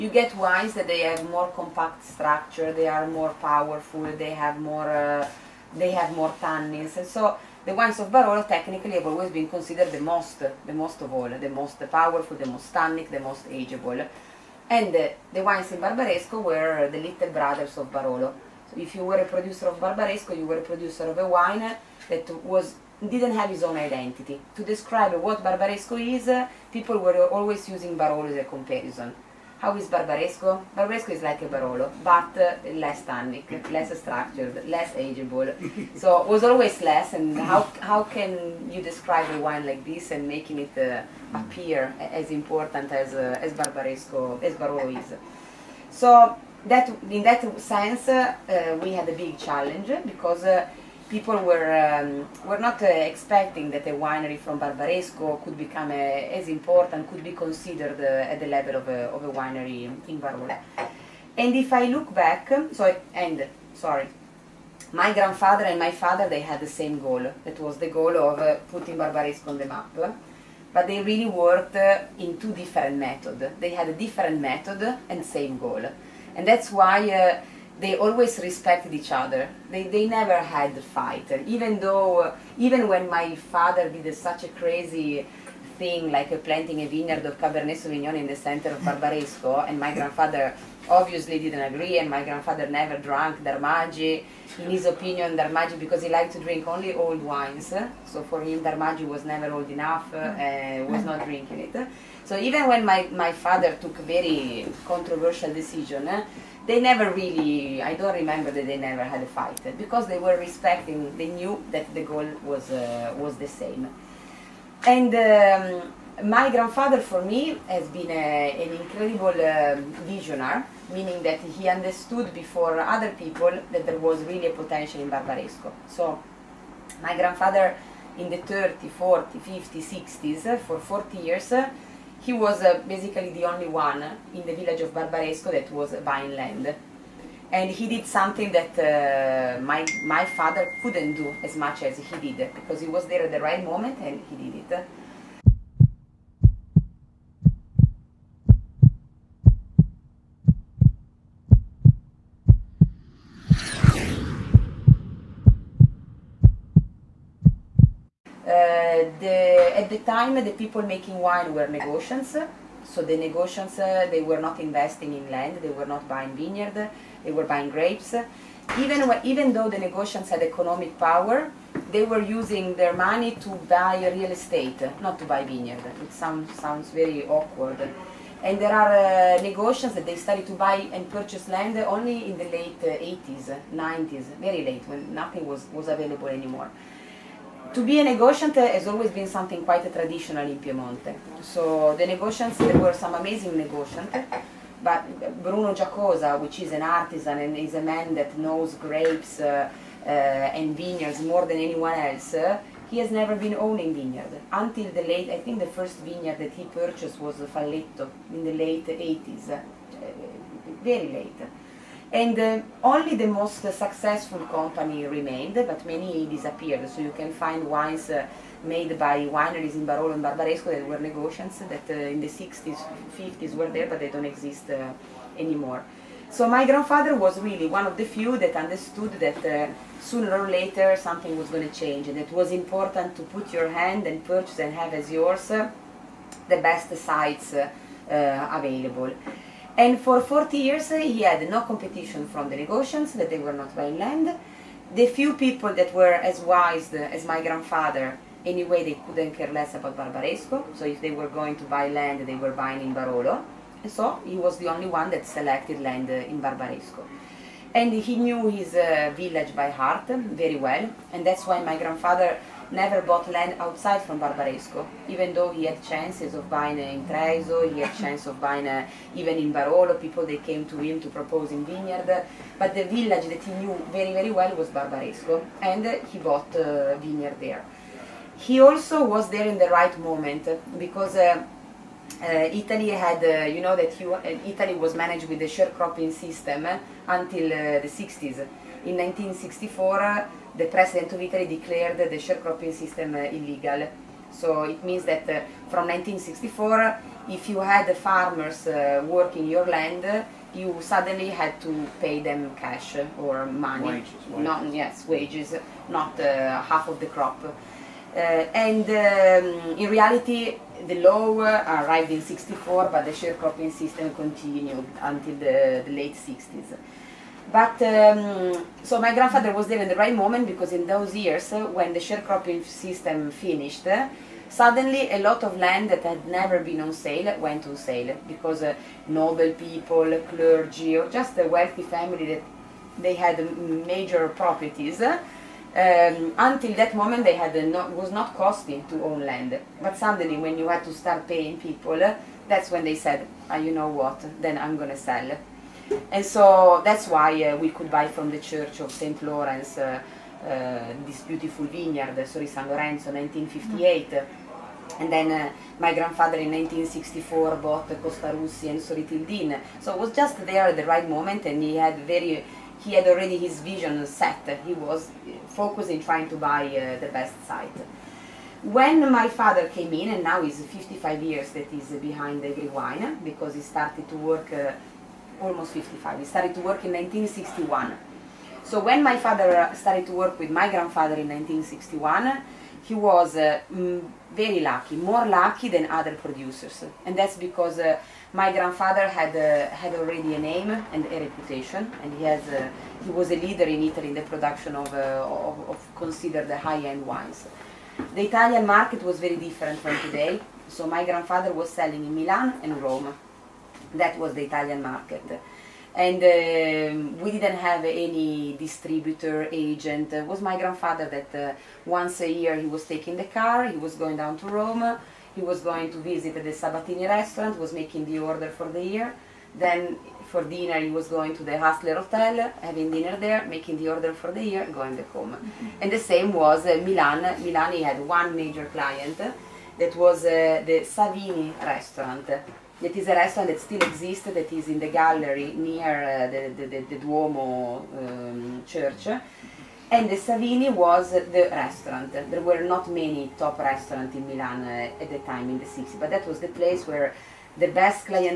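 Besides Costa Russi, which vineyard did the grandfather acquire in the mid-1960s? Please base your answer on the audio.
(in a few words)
Sori Tildin.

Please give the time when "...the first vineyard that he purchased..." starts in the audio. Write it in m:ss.
3:25.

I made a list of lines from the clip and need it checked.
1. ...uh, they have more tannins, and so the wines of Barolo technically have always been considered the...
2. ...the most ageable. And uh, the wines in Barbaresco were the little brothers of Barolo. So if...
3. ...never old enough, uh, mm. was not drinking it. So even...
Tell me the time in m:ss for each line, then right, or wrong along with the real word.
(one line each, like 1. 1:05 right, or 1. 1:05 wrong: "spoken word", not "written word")
1. 0:04 right
2. 0:13 right
3. 1:39 right.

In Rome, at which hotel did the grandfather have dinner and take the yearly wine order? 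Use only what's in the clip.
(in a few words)
Hassler Hotel.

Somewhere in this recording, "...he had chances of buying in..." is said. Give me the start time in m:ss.
4:25.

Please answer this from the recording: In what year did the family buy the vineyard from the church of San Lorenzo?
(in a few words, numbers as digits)
1958.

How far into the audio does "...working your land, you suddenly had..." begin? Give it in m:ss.
4:59.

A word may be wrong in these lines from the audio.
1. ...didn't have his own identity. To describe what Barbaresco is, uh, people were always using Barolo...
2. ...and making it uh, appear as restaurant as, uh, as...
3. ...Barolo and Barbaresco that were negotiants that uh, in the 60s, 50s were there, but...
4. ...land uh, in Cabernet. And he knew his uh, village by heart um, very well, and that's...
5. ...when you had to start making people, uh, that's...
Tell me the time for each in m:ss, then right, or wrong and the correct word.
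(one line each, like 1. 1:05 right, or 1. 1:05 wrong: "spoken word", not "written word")
1. 0:23 right
2. 0:40 wrong: "important", not "restaurant"
3. 3:39 right
4. 4:15 wrong: "Barbaresco", not "Cabernet"
5. 5:40 wrong: "paying", not "making".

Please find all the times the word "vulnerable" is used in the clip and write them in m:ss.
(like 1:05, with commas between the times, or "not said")
not said.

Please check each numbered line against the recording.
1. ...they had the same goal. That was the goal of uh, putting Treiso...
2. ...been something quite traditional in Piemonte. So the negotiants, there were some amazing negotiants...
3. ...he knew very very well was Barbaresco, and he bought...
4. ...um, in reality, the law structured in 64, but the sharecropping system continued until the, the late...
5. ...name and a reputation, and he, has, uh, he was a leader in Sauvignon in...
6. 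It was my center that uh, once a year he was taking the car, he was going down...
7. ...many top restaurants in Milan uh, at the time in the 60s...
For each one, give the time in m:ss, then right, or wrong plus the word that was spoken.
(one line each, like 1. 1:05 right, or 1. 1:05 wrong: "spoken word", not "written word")
1. 1:06 wrong: "Barbaresco", not "Treiso"
2. 3:09 right
3. 4:33 right
4. 5:08 wrong: "arrived", not "structured"
5. 6:30 wrong: "Italy", not "Sauvignon"
6. 6:50 wrong: "grandfather", not "center"
7. 7:22 right.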